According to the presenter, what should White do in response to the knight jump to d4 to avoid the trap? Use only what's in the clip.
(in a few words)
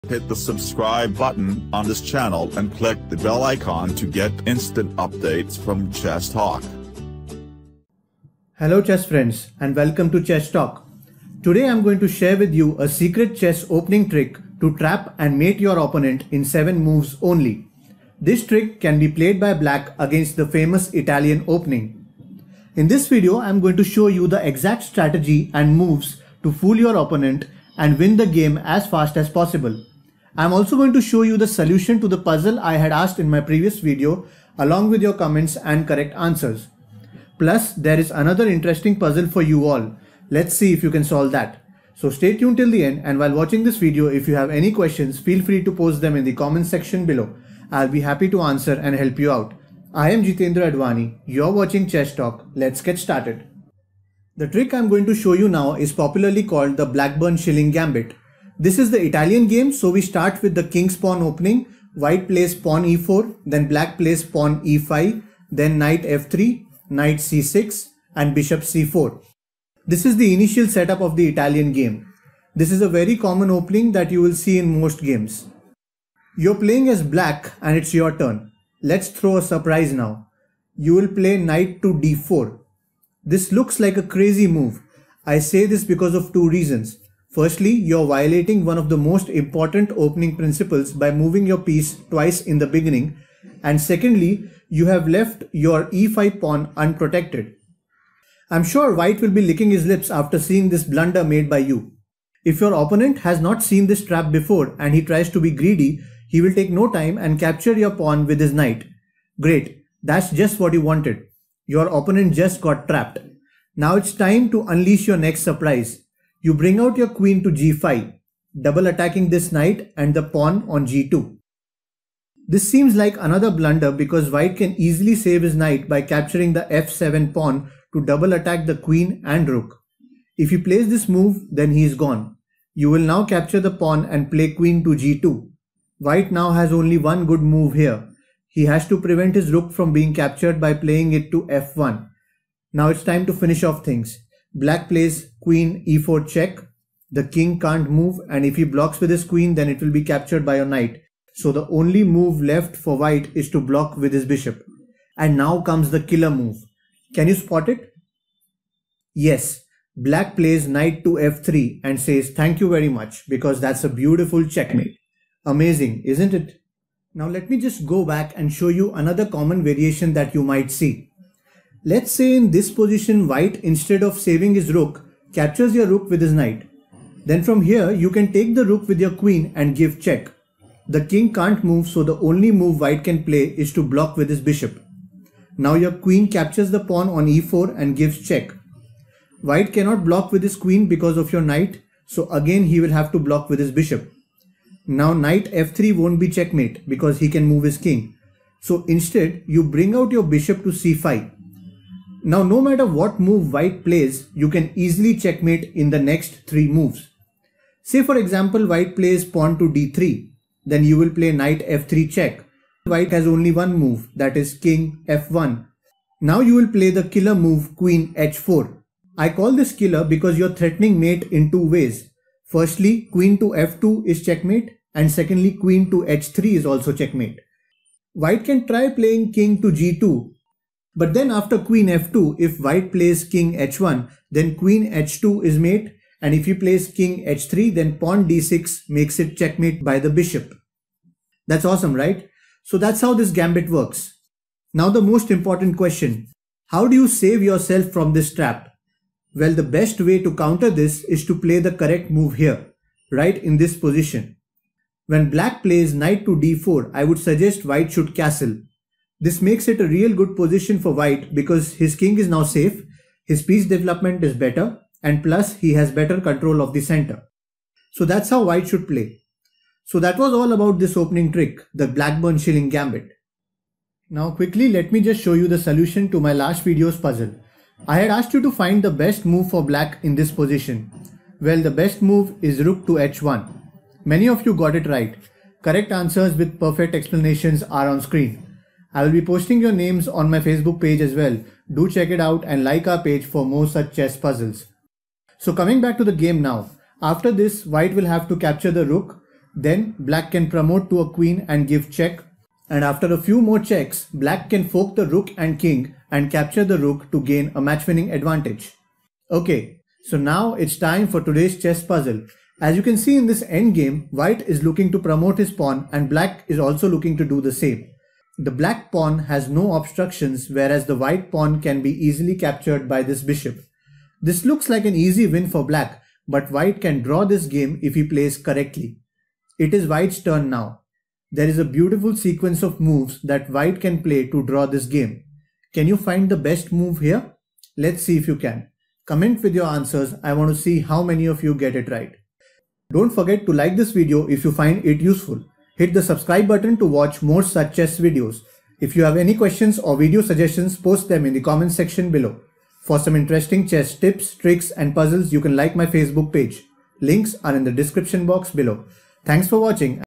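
castle.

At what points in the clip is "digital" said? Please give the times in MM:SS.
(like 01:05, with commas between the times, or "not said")
not said.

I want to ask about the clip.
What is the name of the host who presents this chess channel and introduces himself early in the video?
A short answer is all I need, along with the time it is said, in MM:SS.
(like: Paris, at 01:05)
Jitendra Advani, at 00:50.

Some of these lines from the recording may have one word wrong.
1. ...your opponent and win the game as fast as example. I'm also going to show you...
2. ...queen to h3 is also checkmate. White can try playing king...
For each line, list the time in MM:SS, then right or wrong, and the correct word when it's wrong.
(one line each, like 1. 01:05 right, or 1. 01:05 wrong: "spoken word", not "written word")
1. 00:26 wrong: "possible", not "example"
2. 03:45 right.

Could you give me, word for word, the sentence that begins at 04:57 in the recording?
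After this, white will have to capture the rook.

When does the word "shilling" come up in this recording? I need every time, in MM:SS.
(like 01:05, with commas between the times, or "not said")
00:57, 04:32.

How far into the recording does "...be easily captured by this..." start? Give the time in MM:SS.
05:21.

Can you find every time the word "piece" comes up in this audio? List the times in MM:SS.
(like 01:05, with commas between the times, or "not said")
01:31, 04:23.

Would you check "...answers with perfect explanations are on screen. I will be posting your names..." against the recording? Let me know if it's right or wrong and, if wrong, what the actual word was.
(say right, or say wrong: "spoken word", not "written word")
right.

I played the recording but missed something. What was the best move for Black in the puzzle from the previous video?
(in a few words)
rook to h1.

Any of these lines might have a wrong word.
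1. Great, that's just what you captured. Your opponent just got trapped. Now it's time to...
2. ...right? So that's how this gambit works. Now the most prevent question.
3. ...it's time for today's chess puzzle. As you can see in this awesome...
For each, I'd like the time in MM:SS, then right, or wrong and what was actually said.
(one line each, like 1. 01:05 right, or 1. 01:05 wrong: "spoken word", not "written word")
1. 01:49 wrong: "wanted", not "captured"
2. 04:01 wrong: "important", not "prevent"
3. 05:10 wrong: "endgame", not "awesome".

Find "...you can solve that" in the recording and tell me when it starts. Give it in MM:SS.
00:40.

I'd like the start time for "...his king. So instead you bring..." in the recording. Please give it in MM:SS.
03:17.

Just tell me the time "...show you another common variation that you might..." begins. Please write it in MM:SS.
02:48.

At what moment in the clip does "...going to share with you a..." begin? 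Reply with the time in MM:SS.
00:11.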